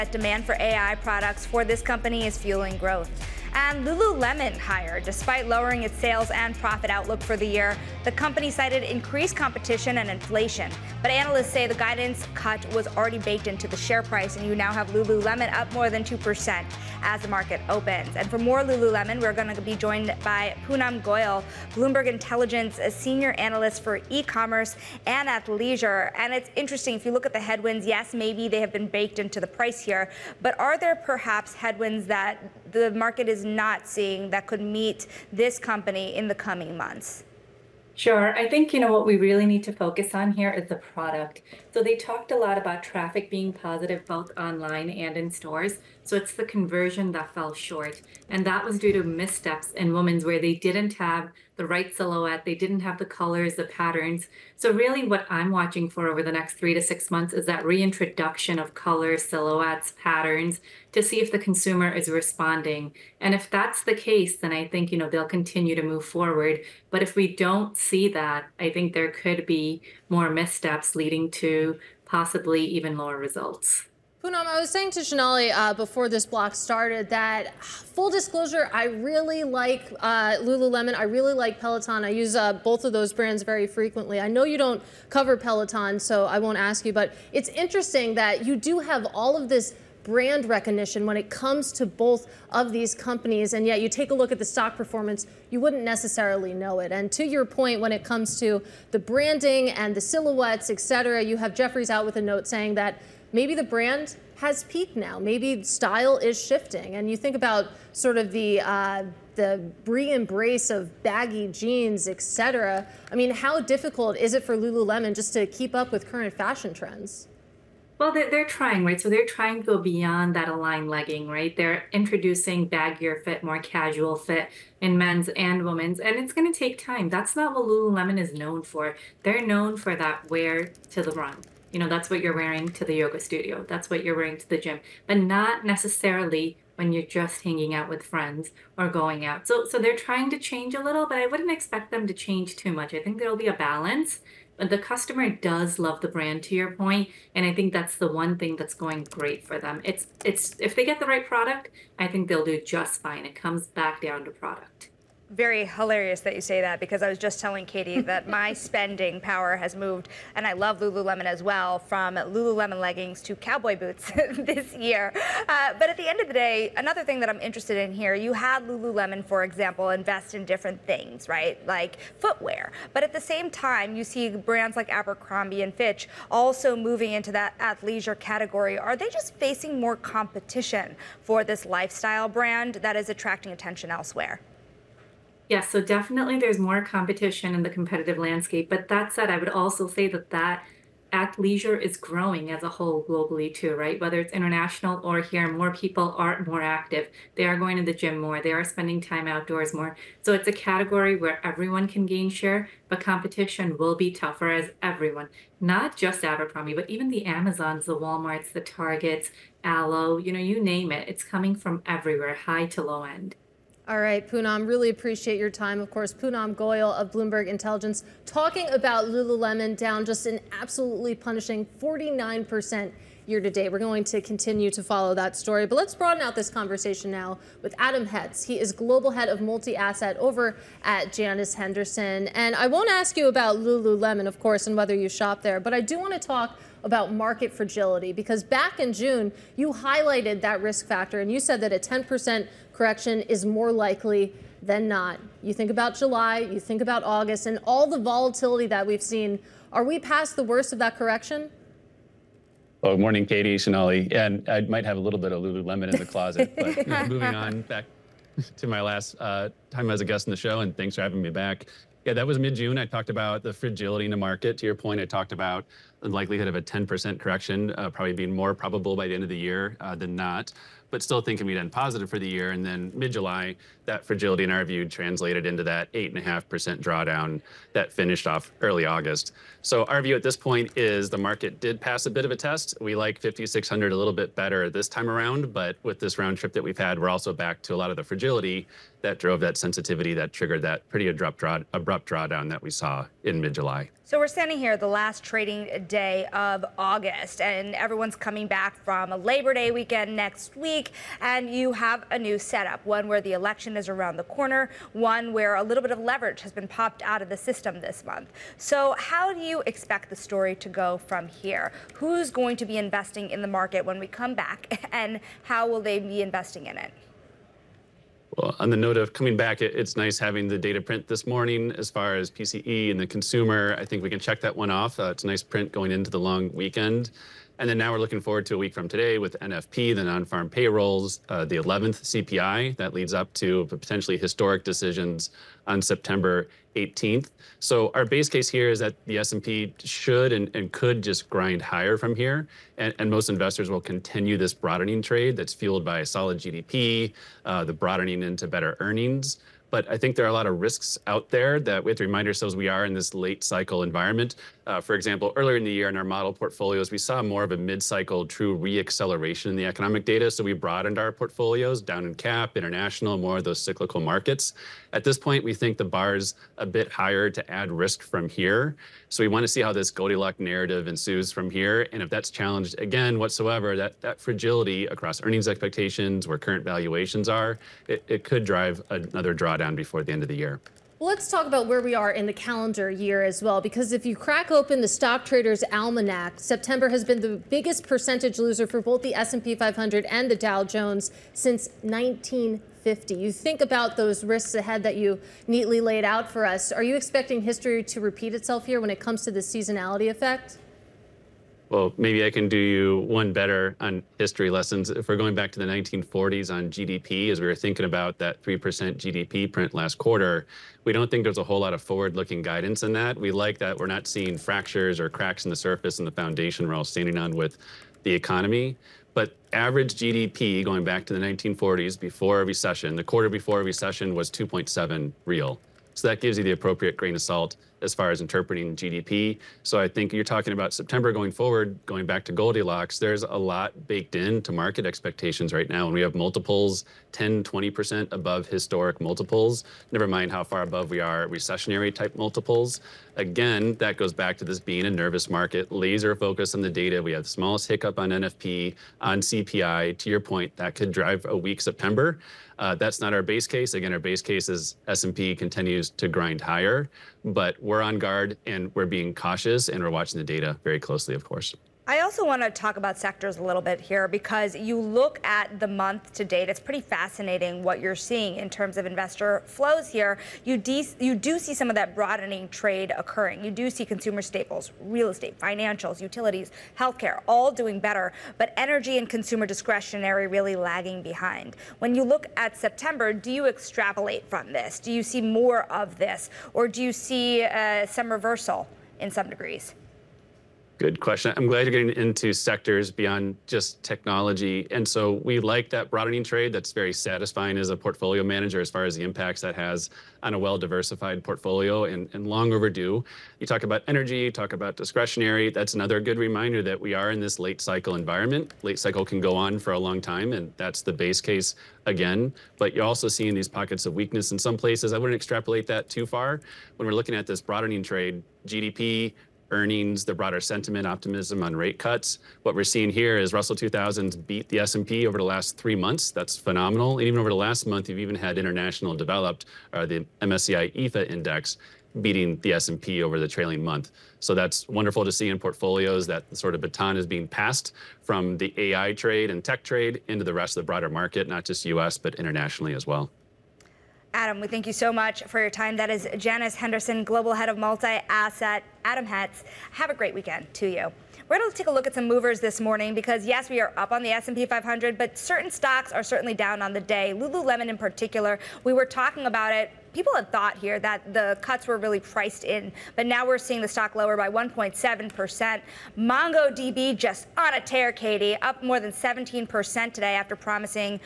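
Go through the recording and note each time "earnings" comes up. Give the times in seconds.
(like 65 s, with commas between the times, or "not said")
348 s, 375 s, 519 s.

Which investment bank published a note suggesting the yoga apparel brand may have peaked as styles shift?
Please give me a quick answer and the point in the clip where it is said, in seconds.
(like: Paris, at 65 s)
Jefferies, at 101 s.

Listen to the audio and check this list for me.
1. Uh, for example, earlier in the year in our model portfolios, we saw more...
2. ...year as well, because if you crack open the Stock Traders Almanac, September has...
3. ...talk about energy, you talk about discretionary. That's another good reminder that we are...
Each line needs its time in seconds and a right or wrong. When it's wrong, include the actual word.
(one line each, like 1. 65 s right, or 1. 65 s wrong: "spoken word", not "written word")
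1. 354 s right
2. 382 s right
3. 503 s right.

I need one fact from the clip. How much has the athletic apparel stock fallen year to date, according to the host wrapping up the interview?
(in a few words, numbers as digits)
49%.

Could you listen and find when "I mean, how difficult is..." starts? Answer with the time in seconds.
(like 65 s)
113 s.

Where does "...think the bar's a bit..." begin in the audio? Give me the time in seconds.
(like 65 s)
365 s.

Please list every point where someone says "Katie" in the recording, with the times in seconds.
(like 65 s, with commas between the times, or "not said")
157 s, 253 s, 567 s.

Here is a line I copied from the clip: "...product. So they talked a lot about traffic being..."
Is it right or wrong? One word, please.
right.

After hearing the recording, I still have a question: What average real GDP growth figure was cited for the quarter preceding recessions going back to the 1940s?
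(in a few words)
2.7.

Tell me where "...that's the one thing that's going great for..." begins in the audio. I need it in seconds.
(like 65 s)
147 s.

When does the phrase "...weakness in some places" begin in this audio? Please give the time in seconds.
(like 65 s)
513 s.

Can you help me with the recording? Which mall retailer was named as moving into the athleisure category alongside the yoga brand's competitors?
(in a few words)
Abercrombie and Fitch.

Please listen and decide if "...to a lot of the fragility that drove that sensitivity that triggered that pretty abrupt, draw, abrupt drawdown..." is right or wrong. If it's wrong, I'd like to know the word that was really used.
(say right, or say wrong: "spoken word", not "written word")
right.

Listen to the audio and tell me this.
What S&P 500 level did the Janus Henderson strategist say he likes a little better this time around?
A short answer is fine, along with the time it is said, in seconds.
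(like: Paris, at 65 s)
5,600, at 283 s.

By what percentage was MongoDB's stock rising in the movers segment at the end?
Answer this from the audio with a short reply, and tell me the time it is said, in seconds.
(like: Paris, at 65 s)
More than 17%, at 568 s.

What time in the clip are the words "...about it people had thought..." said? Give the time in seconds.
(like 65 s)
559 s.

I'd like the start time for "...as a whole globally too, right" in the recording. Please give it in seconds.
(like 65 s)
192 s.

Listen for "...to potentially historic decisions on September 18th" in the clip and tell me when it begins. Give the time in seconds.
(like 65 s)
333 s.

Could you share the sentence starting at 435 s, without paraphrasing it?
And we have multiples 10, 20% above historic multiples, never mind how far above we are recessionary type multiples.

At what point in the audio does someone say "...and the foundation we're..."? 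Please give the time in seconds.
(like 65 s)
415 s.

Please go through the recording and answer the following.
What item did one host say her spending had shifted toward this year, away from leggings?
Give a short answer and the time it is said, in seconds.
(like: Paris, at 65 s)
Cowboy boots, at 163 s.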